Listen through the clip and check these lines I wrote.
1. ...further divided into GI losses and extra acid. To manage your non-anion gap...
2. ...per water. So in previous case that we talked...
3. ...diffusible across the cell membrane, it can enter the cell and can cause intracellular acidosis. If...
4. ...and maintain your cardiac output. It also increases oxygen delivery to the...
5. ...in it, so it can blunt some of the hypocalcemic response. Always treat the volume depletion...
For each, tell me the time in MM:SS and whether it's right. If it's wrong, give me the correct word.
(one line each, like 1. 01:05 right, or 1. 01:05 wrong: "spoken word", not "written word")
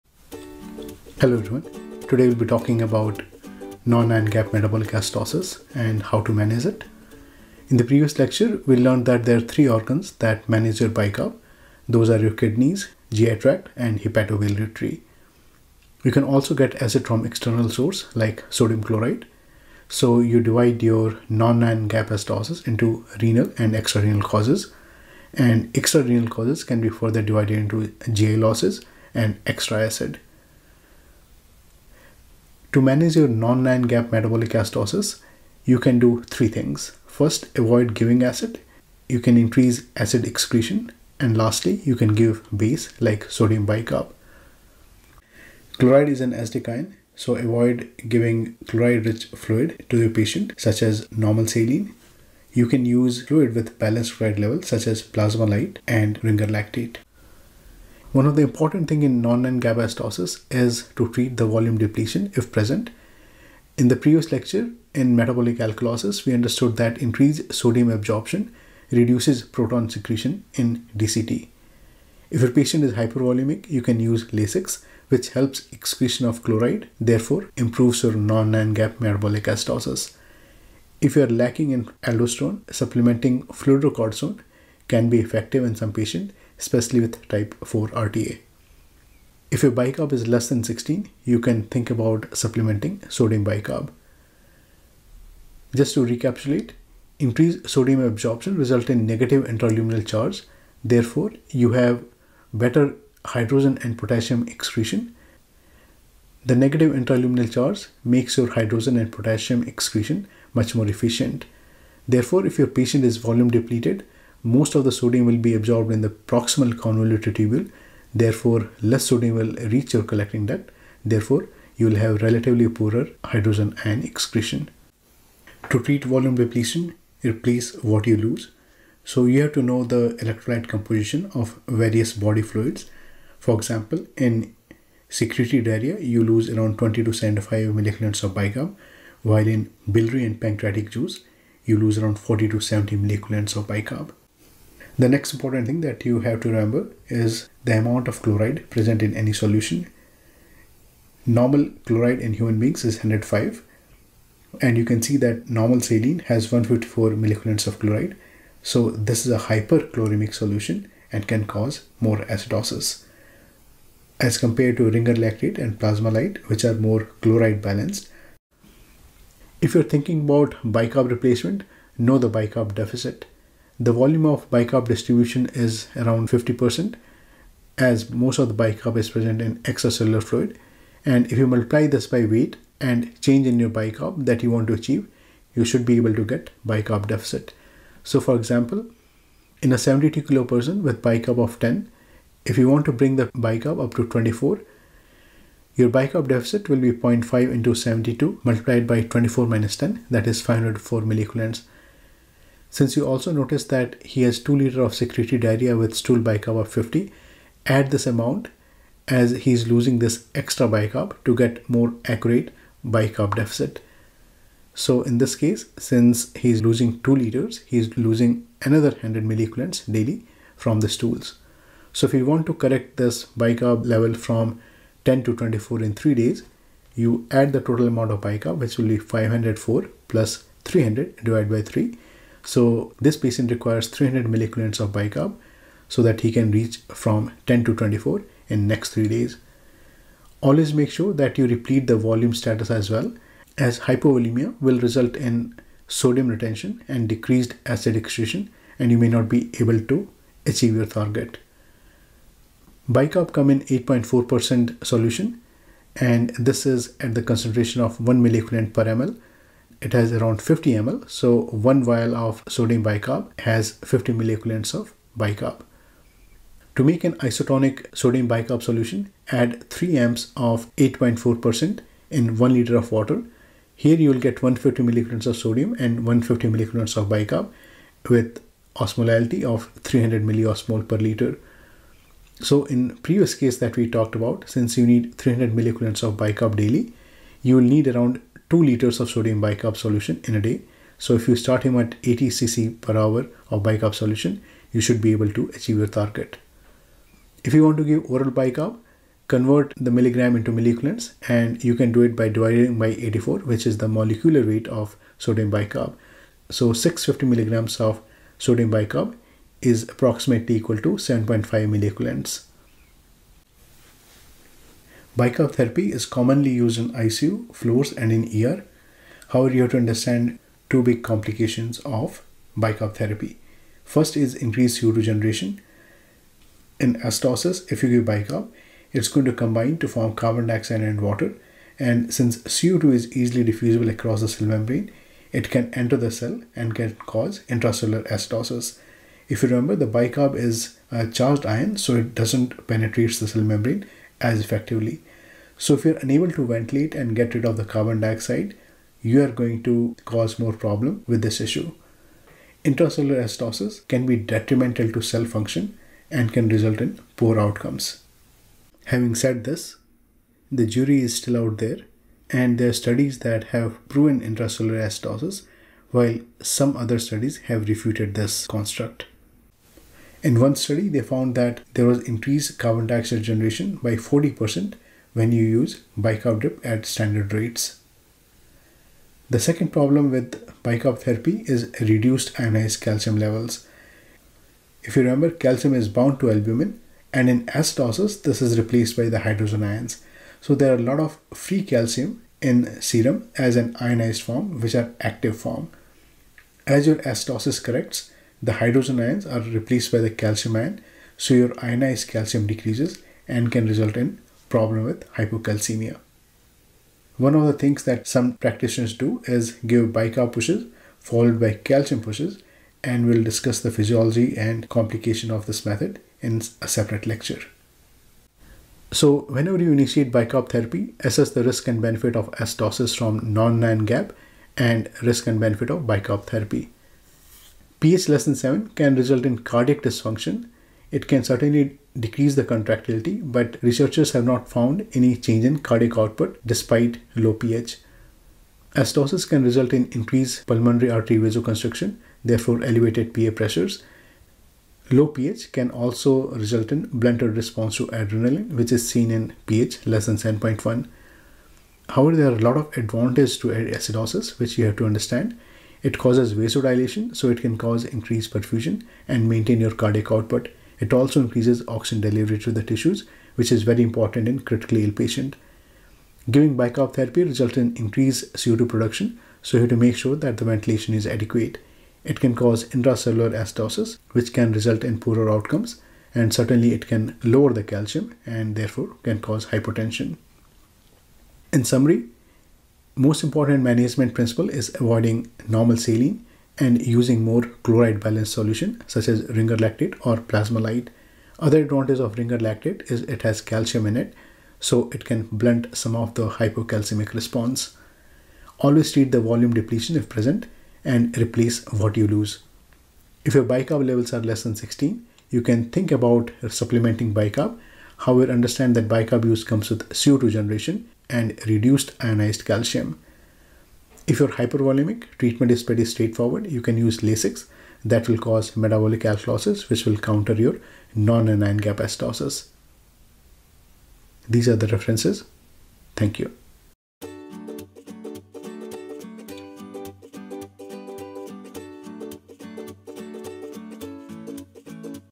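1. 00:26 right
2. 04:40 wrong: "liter", not "water"
3. 05:33 right
4. 07:39 right
5. 08:13 right.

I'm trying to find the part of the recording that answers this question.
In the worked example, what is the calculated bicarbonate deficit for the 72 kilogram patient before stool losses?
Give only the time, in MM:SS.
03:20.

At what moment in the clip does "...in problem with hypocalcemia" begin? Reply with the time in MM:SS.
06:43.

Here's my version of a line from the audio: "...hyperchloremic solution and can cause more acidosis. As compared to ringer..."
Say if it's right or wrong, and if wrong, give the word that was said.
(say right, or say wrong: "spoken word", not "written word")
right.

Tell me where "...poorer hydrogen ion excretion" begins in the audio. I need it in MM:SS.
02:02.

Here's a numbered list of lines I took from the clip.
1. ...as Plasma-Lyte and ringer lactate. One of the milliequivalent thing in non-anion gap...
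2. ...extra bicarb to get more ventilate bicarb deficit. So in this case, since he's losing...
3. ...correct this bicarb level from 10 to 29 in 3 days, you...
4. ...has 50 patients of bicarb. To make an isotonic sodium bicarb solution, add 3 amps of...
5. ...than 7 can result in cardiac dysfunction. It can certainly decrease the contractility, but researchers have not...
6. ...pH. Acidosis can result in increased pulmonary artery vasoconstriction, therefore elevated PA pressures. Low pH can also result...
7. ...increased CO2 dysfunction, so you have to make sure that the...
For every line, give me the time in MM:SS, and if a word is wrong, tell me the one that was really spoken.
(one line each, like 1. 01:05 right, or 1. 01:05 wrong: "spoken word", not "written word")
1. 00:54 wrong: "important", not "milliequivalent"
2. 03:30 wrong: "accurate", not "ventilate"
3. 03:42 wrong: "24", not "29"
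4. 04:23 wrong: "milliequivalents", not "patients"
5. 07:08 right
6. 07:17 right
7. 07:47 wrong: "production", not "dysfunction".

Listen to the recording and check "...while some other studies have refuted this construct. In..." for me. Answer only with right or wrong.
right.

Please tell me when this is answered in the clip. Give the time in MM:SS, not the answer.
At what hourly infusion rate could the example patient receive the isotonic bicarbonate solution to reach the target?
04:52.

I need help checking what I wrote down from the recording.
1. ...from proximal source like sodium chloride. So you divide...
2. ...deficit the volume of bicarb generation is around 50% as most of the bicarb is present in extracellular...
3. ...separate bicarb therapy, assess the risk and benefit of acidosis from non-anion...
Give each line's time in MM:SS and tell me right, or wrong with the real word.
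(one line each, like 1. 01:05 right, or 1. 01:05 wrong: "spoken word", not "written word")
1. 00:17 wrong: "external", not "proximal"
2. 02:52 wrong: "distribution", not "generation"
3. 06:59 wrong: "initiate", not "separate".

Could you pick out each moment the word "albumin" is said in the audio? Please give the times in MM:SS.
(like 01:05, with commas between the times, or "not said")
06:26.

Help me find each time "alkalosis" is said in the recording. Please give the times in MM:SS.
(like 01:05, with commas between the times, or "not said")
01:05, 08:39.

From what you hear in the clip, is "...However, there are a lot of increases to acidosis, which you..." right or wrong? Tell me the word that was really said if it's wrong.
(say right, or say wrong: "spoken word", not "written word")
wrong: "advantages", not "increases".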